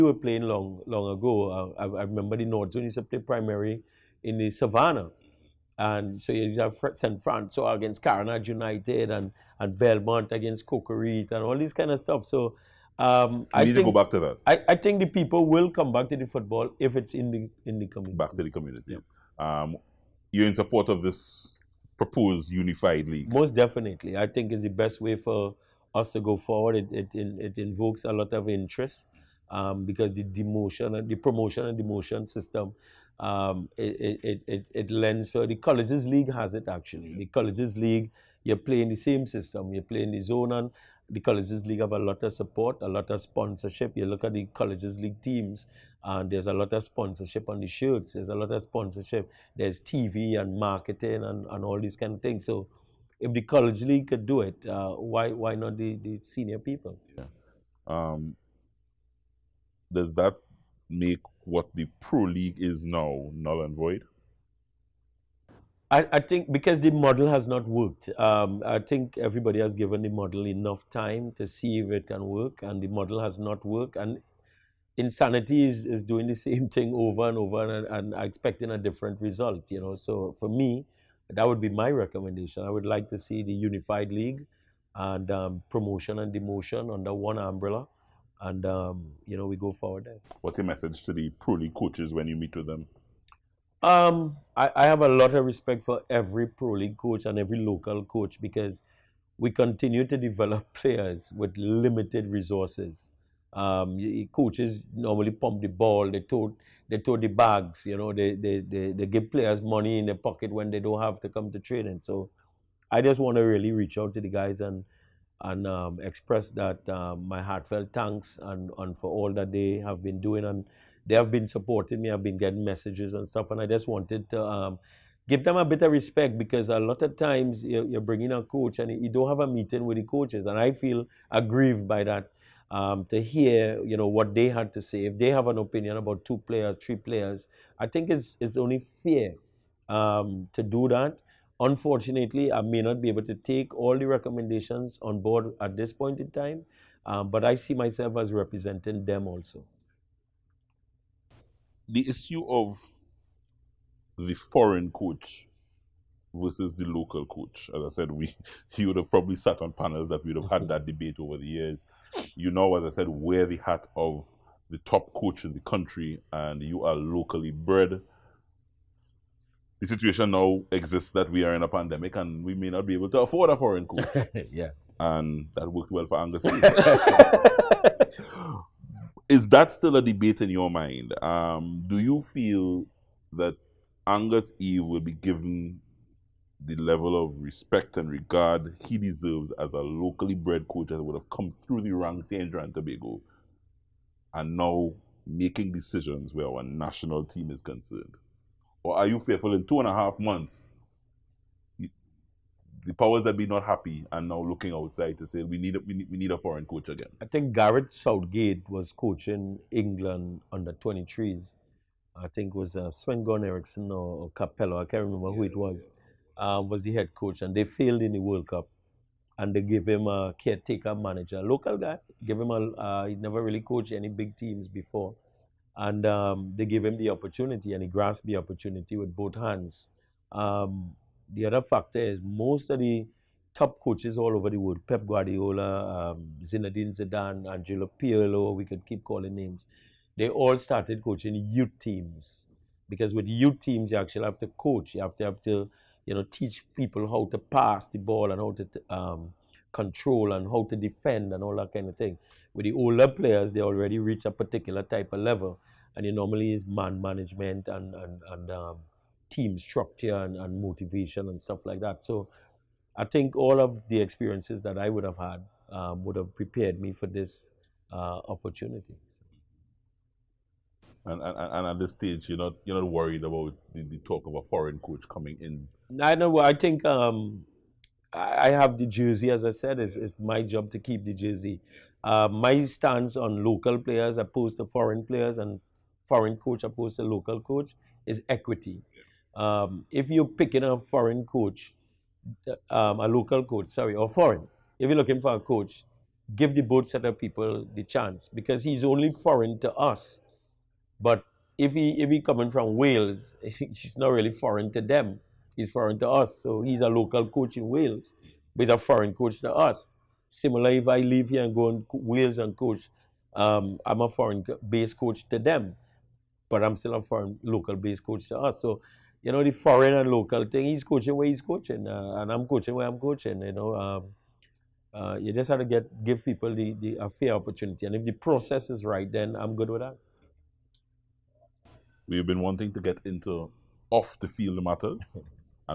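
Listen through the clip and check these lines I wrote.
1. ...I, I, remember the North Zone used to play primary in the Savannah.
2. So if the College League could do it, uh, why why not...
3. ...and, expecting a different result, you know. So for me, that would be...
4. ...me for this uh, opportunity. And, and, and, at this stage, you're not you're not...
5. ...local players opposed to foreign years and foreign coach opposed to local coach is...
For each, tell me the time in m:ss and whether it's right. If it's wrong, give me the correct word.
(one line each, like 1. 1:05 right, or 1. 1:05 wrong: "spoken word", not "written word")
1. 0:01 right
2. 0:52 right
3. 1:18 right
4. 4:26 right
5. 4:43 wrong: "players", not "years".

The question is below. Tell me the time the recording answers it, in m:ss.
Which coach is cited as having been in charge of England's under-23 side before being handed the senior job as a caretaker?
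3:27.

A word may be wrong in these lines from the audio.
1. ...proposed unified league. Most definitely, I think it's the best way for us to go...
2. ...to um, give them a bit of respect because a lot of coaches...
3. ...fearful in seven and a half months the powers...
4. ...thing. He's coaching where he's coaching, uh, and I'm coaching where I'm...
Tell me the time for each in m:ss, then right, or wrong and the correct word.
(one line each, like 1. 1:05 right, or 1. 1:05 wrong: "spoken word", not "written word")
1. 0:21 right
2. 2:04 wrong: "times", not "coaches"
3. 3:19 wrong: "two", not "seven"
4. 5:20 right.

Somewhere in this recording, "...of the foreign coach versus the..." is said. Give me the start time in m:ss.
2:32.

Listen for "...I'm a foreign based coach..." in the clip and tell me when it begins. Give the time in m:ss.
5:13.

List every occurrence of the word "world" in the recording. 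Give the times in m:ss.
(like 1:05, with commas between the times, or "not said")
3:38, 3:54.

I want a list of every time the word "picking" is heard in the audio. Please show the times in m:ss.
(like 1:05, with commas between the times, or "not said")
4:50.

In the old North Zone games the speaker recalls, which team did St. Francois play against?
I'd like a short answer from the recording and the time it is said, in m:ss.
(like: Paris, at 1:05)
Carnage United, at 0:08.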